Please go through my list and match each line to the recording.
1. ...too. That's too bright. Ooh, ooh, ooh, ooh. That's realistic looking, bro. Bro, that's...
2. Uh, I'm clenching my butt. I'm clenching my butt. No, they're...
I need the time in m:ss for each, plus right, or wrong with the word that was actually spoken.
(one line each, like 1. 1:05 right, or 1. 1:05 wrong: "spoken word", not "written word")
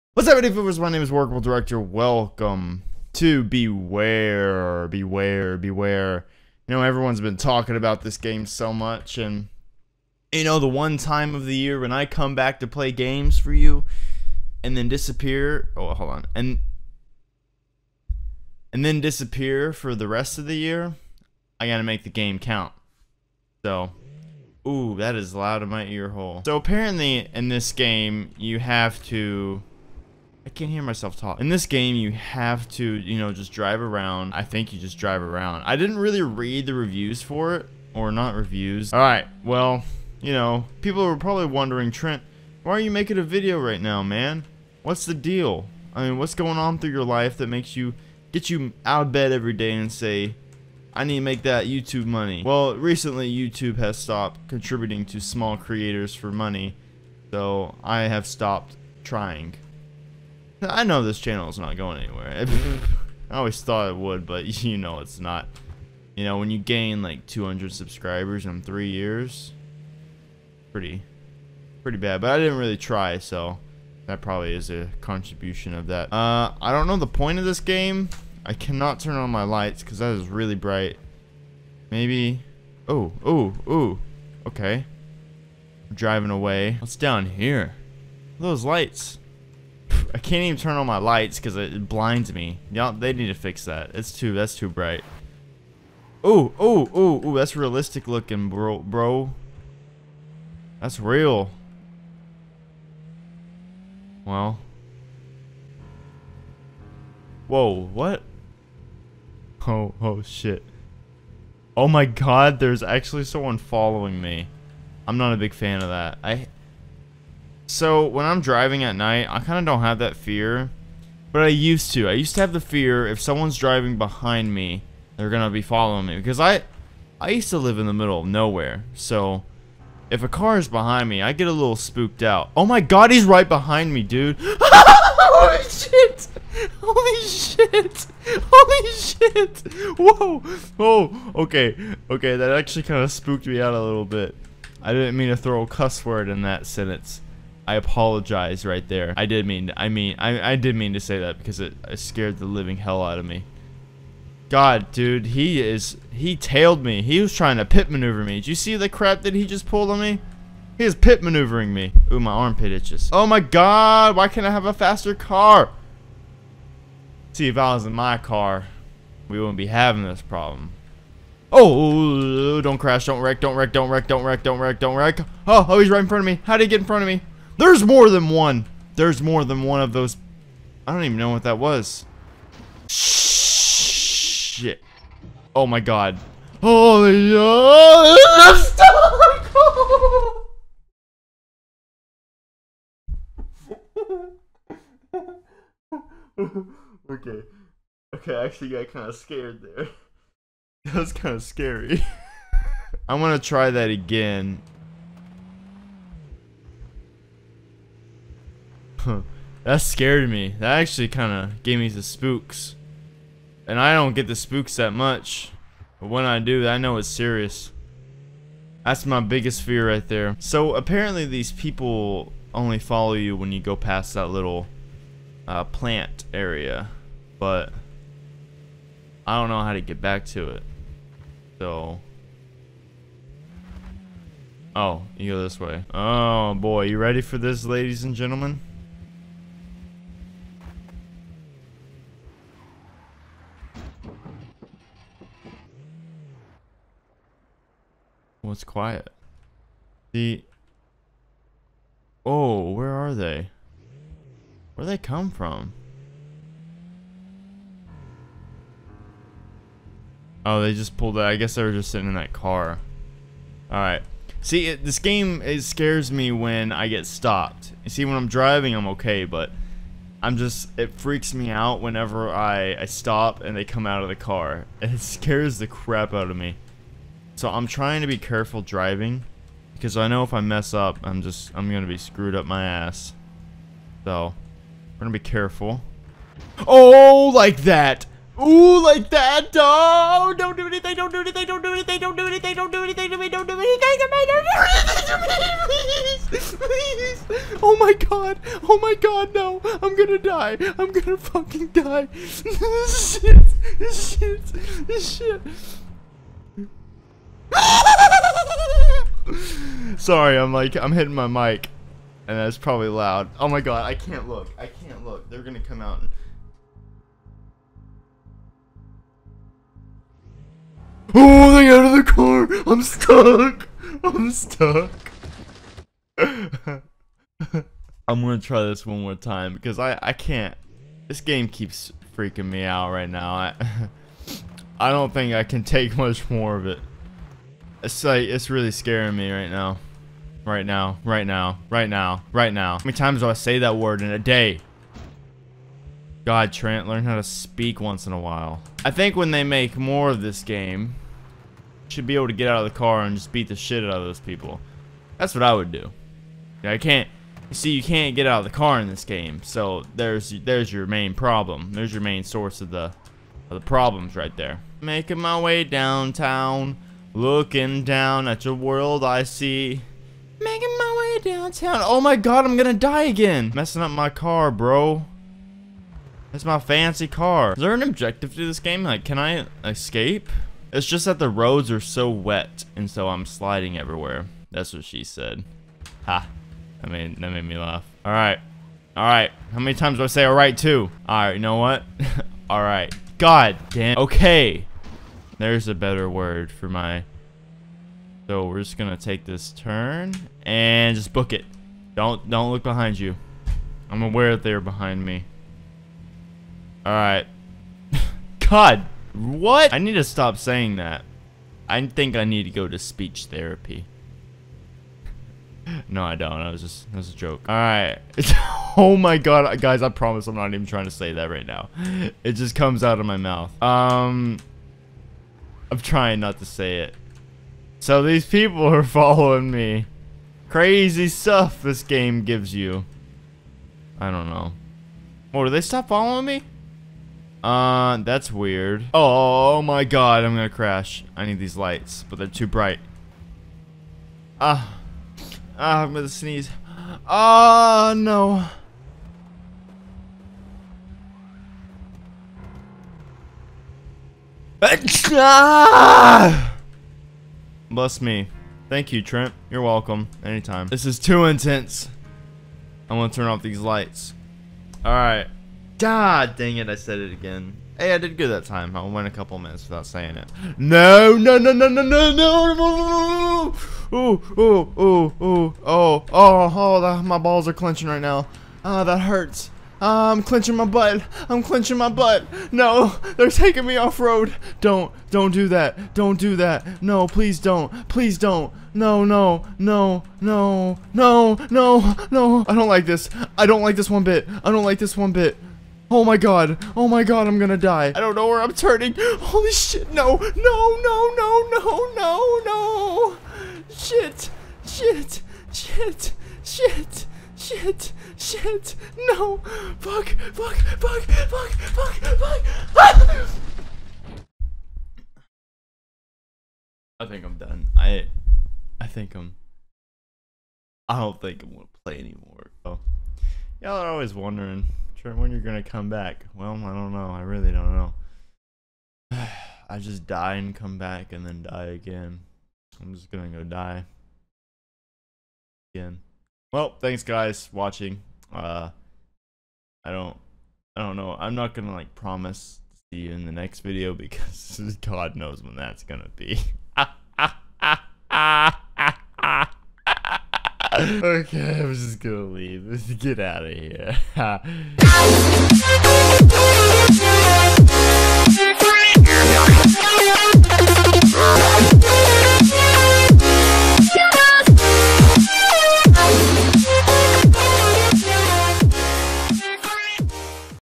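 1. 1:34 right
2. 7:59 right.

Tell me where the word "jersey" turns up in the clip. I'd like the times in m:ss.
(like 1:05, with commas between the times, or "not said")
not said.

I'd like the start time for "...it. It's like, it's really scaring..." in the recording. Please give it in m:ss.
5:36.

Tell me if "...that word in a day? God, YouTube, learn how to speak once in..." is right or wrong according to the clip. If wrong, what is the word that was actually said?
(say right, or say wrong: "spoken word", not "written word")
wrong: "Trent", not "YouTube".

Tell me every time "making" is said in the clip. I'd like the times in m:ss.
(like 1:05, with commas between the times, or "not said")
0:42, 6:04, 6:10.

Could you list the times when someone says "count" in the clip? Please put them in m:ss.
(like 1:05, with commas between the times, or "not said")
0:22.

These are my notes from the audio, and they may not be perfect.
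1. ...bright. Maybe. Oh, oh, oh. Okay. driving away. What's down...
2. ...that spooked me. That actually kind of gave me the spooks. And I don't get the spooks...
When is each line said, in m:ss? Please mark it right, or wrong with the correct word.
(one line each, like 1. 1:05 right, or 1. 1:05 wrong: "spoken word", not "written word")
1. 1:20 right
2. 3:29 wrong: "scared", not "spooked".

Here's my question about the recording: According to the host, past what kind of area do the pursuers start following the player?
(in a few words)
plant area.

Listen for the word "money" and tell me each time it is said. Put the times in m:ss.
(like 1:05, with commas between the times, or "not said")
0:52, 0:56.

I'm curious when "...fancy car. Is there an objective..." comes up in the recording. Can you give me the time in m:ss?
6:16.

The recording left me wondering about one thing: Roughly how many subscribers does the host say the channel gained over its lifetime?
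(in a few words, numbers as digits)
200.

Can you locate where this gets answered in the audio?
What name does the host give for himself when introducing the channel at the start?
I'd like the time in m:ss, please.
0:01.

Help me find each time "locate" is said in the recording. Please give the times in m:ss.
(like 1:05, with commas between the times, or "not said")
not said.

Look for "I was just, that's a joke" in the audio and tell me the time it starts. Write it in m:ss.
6:56.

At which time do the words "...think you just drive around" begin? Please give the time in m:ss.
0:34.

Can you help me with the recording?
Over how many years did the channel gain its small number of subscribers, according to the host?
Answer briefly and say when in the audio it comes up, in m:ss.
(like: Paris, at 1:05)
3, at 1:08.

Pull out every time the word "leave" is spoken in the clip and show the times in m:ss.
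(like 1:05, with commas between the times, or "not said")
9:12.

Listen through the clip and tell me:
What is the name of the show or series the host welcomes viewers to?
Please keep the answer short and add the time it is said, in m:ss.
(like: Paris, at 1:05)
Beware, Beware, Beware, at 0:03.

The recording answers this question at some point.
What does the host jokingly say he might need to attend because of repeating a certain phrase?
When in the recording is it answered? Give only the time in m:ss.
6:52.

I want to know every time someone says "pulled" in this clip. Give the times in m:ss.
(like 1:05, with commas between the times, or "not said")
2:39, 4:20.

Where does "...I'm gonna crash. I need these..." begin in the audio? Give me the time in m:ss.
7:20.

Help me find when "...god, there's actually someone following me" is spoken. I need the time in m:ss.
1:52.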